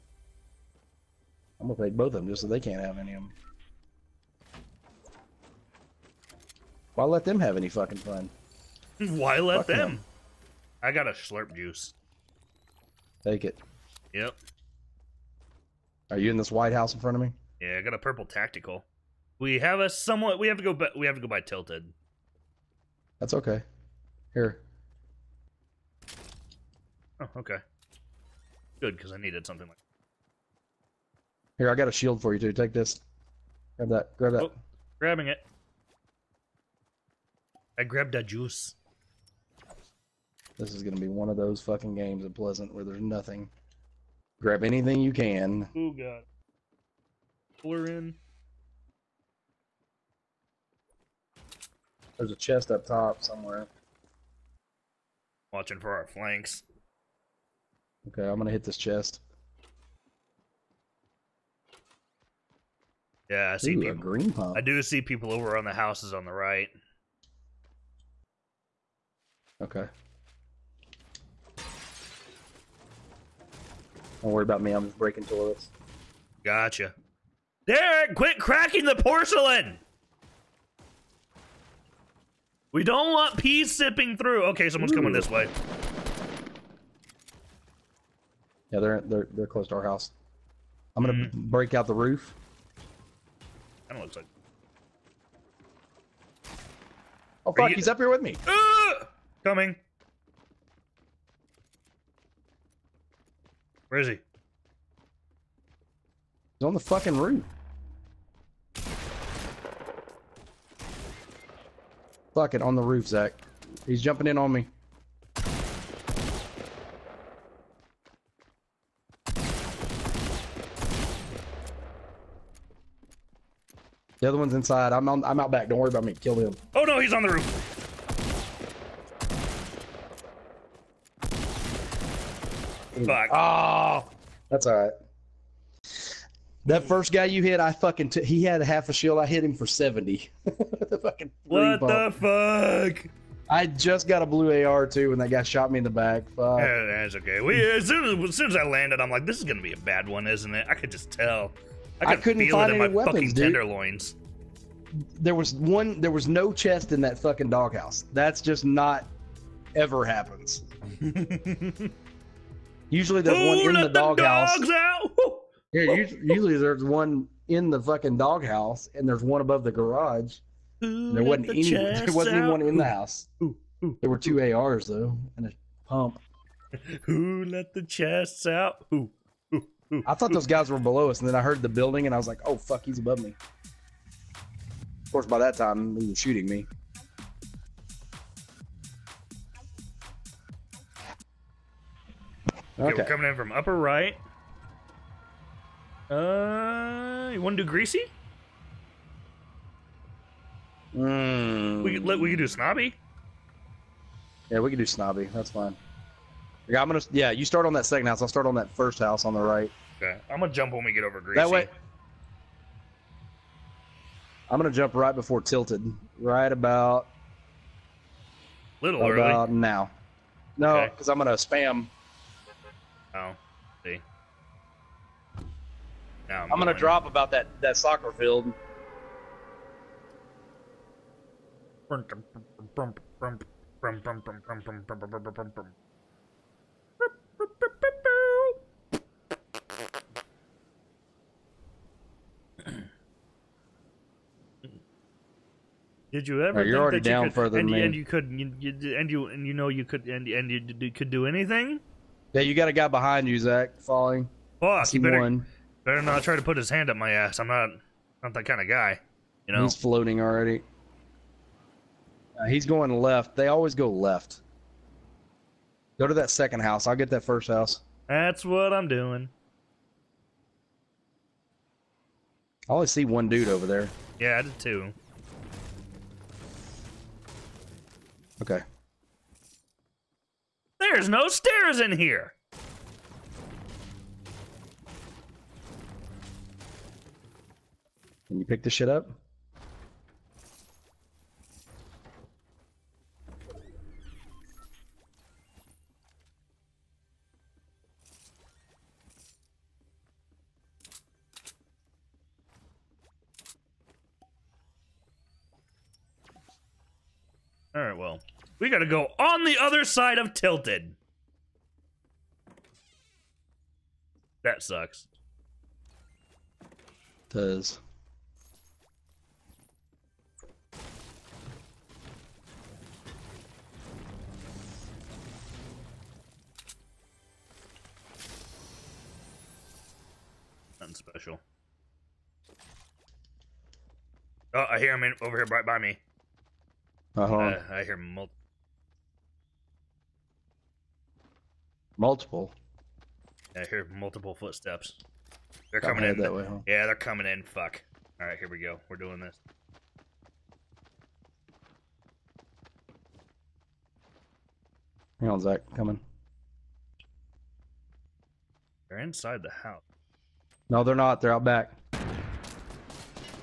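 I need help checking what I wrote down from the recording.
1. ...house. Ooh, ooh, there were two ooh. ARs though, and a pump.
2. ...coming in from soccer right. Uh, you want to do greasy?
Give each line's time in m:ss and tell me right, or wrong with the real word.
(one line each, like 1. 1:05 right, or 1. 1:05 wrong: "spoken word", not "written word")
1. 2:52 right
2. 3:13 wrong: "upper", not "soccer".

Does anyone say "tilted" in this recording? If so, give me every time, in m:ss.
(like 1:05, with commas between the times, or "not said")
0:21, 3:35, 5:10.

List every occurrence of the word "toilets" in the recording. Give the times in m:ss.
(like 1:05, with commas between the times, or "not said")
1:15.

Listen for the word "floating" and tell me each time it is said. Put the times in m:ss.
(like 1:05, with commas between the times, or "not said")
4:19.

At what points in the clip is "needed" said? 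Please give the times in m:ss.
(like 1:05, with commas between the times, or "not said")
0:29.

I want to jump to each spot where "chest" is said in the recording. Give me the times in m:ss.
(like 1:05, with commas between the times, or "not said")
0:52, 0:58, 2:36, 2:57.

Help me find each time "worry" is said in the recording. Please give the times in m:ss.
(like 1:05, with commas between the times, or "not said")
1:14, 2:05.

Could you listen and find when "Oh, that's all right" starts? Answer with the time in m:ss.
2:13.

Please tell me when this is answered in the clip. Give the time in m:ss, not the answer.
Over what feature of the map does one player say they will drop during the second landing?
3:47.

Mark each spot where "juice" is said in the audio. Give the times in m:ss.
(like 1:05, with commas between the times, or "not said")
0:11, 0:38.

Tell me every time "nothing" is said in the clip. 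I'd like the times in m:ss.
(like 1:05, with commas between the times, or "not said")
0:43, 5:30.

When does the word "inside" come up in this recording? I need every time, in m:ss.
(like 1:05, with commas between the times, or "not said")
2:04, 5:59.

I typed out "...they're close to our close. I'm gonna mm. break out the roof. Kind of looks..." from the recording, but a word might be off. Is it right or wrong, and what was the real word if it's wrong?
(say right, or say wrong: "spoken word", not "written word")
wrong: "house", not "close".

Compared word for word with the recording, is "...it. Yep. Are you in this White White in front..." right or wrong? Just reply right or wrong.
wrong.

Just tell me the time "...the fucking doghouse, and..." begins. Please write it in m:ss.
2:47.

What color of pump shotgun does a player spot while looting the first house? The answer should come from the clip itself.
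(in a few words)
Green.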